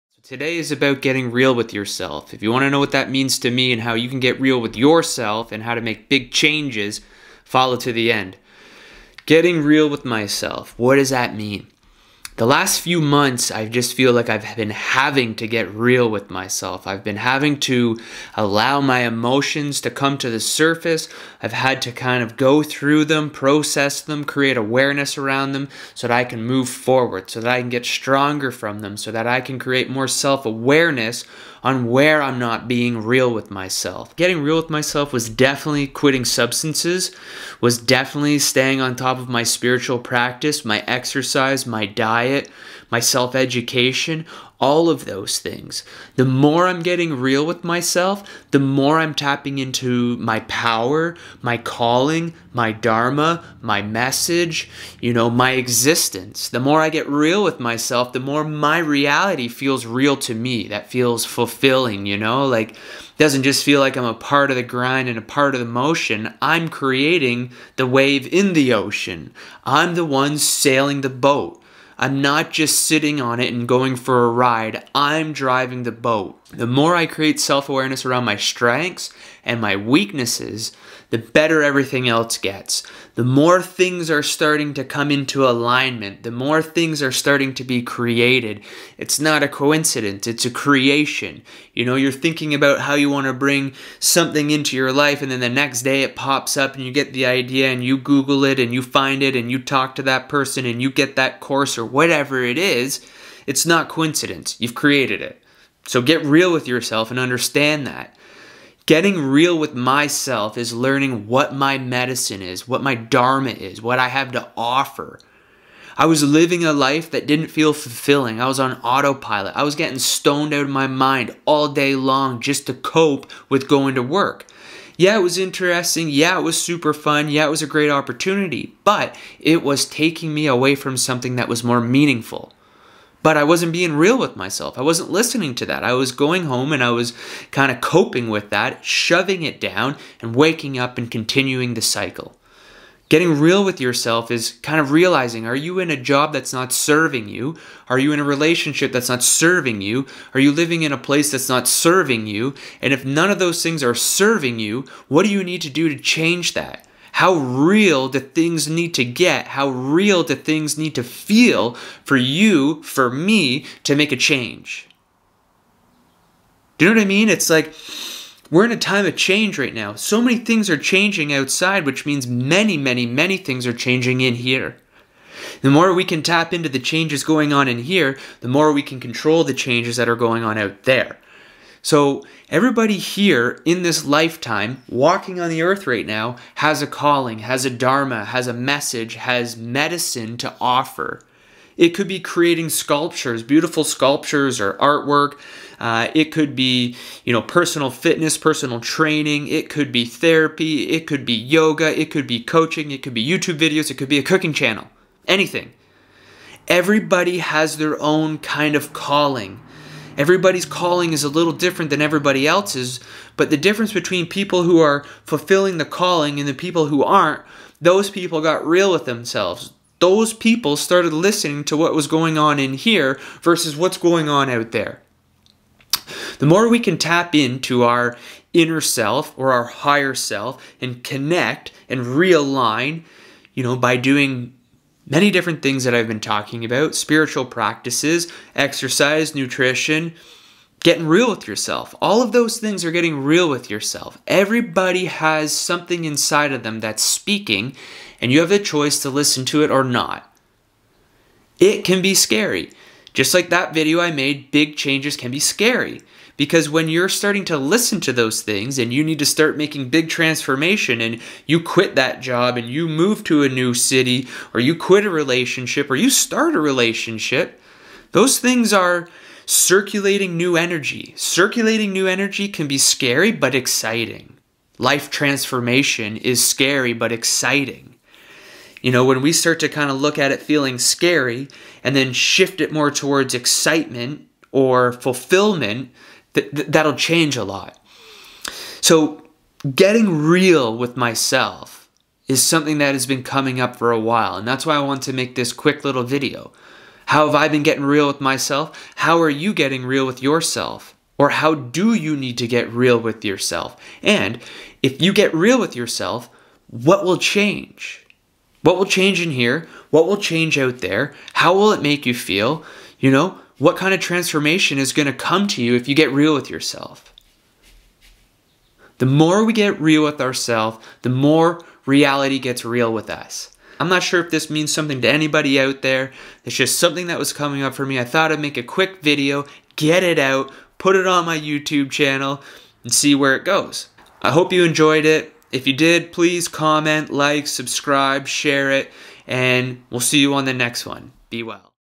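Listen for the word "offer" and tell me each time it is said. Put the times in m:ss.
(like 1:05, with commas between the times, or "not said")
1:54, 3:10.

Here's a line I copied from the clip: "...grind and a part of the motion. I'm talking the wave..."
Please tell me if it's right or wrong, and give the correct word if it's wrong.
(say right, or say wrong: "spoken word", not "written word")
wrong: "creating", not "talking".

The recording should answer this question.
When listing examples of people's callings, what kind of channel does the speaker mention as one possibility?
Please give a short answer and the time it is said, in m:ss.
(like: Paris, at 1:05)
A cooking channel, at 3:24.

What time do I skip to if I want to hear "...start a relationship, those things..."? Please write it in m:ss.
4:26.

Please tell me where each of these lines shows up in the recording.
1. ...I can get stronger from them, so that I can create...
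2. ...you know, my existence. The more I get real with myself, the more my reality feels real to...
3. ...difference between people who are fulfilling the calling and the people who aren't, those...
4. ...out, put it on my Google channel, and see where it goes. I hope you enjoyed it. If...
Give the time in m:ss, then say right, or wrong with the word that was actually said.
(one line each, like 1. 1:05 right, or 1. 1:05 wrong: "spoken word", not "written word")
1. 0:27 right
2. 0:55 right
3. 3:33 right
4. 5:30 wrong: "YouTube", not "Google".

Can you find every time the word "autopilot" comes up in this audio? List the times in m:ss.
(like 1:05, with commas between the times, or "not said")
1:58.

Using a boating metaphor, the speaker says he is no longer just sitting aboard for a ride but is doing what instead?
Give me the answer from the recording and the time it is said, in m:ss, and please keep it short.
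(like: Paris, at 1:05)
Driving the boat, at 1:15.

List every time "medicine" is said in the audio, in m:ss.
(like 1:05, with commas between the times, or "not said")
1:51, 3:09.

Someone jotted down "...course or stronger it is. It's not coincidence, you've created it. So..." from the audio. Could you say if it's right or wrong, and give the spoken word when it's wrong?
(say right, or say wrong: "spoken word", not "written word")
wrong: "whatever", not "stronger".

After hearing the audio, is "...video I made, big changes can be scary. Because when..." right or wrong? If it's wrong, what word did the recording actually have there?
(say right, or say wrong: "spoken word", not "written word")
right.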